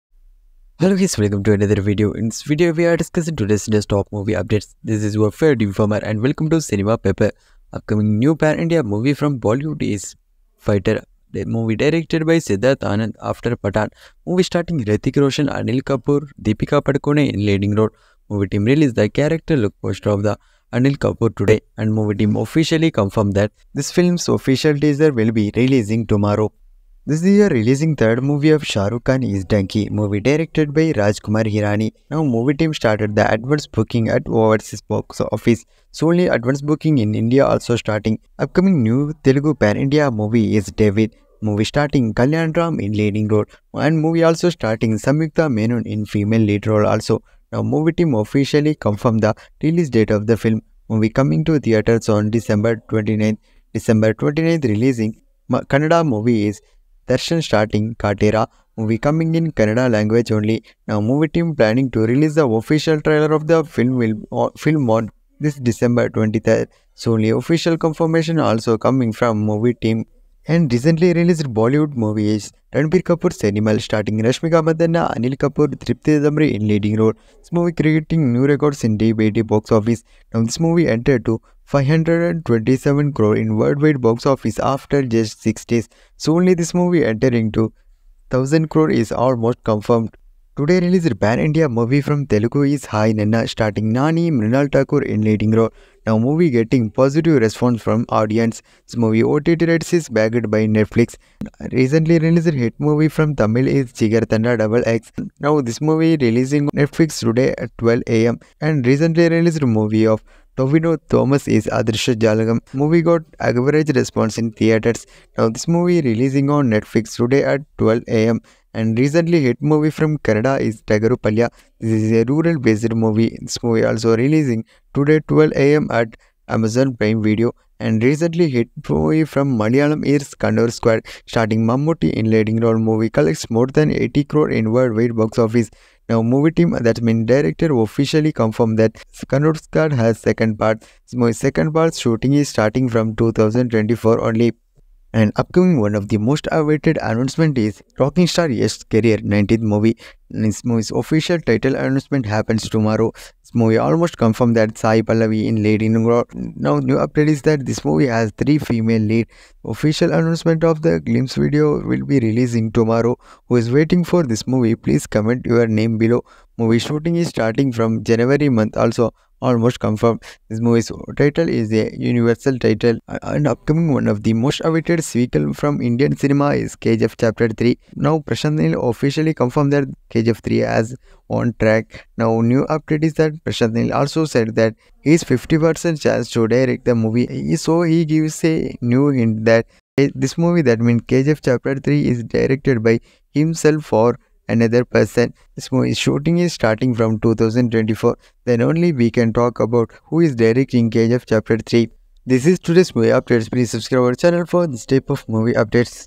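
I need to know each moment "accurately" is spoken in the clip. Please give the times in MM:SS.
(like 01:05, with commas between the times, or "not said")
not said.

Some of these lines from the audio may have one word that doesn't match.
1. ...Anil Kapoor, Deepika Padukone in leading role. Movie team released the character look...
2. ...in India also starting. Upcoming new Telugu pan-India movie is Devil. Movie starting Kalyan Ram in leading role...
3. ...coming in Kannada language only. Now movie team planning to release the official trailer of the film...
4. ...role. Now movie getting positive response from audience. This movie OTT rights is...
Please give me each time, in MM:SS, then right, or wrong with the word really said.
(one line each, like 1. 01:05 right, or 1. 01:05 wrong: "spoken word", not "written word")
1. 00:15 right
2. 00:36 right
3. 00:59 right
4. 01:35 right.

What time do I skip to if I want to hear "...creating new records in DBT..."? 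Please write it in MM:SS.
01:17.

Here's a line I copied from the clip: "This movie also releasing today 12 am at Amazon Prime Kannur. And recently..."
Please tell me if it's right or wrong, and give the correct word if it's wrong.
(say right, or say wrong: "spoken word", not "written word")
wrong: "Video", not "Kannur".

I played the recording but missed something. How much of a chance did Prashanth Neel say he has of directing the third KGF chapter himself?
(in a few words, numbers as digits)
50%.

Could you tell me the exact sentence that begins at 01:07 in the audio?
only official confirmation also coming from movie team.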